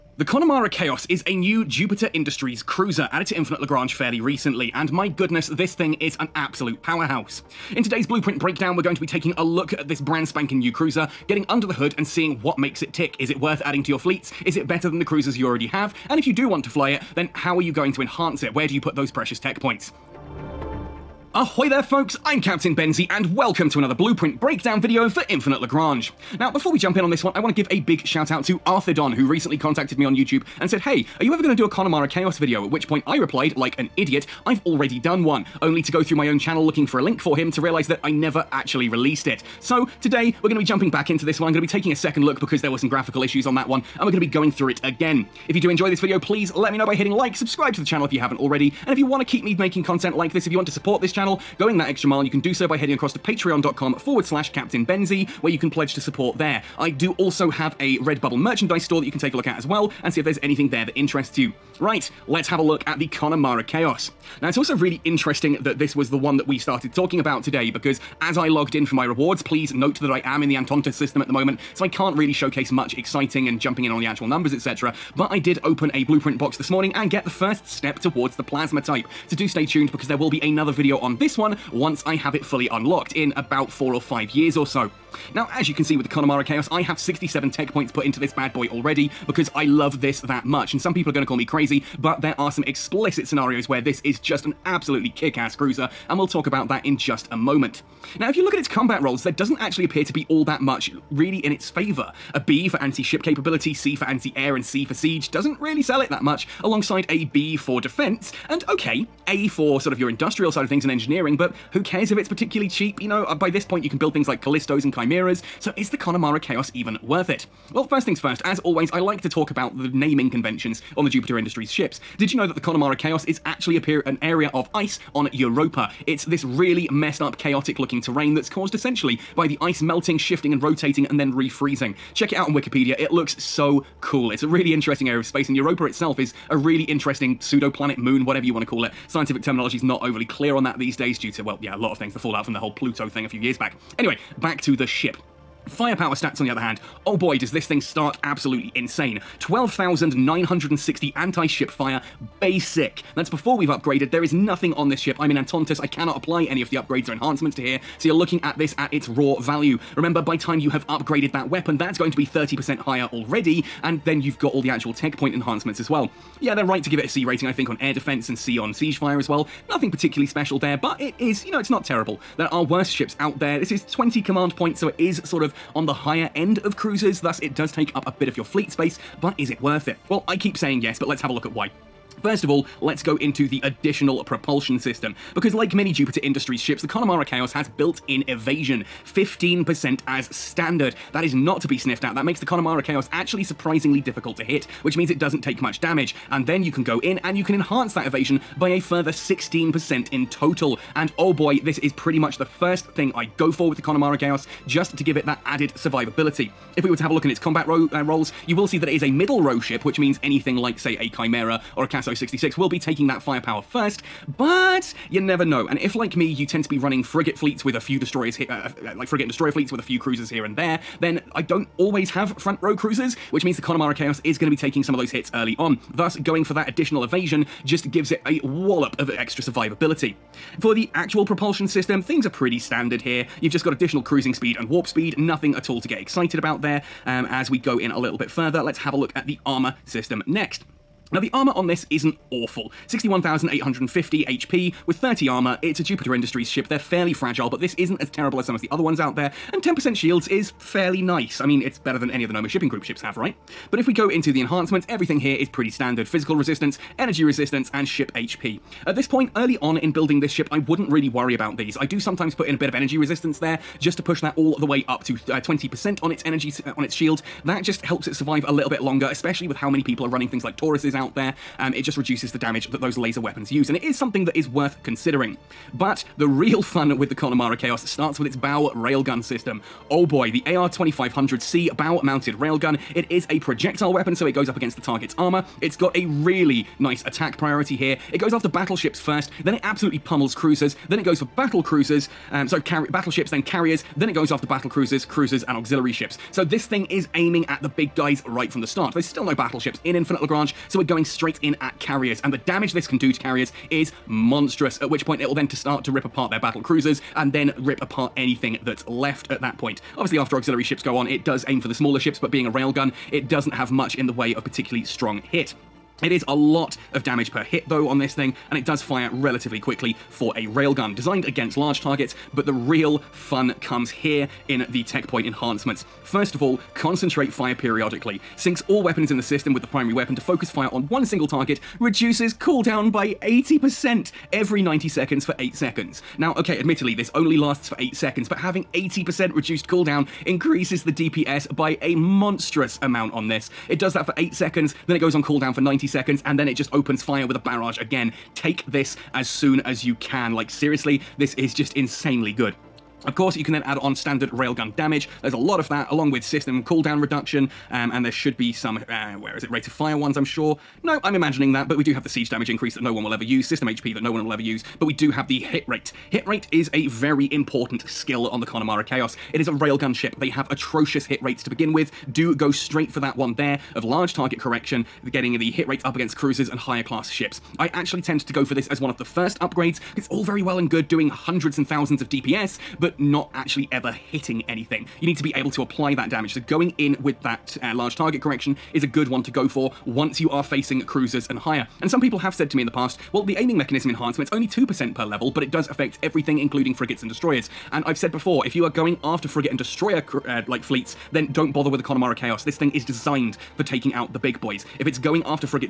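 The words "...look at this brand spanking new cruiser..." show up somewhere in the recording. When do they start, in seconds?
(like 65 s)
9 s.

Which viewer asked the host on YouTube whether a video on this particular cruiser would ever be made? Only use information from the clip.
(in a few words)
Arthur Don.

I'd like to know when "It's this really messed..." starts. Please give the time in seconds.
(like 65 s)
126 s.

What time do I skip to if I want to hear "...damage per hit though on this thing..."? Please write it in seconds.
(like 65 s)
317 s.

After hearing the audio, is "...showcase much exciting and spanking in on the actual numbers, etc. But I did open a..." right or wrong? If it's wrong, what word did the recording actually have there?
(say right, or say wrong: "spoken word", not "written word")
wrong: "jumping", not "spanking".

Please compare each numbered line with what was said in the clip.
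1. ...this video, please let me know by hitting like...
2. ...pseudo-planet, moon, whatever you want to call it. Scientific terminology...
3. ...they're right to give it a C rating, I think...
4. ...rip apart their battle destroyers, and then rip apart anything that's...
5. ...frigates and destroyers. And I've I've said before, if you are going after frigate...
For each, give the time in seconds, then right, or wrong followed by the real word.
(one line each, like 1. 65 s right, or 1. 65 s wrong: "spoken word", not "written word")
1. 45 s right
2. 137 s right
3. 166 s right
4. 305 s wrong: "cruisers", not "destroyers"
5. 396 s right.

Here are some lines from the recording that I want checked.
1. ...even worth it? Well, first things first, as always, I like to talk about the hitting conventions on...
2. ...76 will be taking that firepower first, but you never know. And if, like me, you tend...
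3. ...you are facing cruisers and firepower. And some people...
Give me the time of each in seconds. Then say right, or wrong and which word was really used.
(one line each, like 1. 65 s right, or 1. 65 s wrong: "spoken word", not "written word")
1. 116 s wrong: "naming", not "hitting"
2. 212 s wrong: "66", not "76"
3. 390 s wrong: "higher", not "firepower".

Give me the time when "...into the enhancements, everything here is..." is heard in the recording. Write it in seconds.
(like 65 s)
254 s.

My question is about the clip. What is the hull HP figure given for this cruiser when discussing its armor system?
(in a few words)
61,850.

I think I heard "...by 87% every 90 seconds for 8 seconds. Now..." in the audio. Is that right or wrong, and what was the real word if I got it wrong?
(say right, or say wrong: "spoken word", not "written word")
wrong: "80", not "87".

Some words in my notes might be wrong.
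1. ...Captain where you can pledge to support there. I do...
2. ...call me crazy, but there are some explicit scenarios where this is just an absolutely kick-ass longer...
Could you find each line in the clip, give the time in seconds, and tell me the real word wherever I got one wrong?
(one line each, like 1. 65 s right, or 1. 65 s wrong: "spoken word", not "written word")
1. 54 s right
2. 91 s wrong: "cruiser", not "longer".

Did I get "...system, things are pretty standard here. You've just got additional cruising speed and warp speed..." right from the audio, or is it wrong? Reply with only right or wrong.
right.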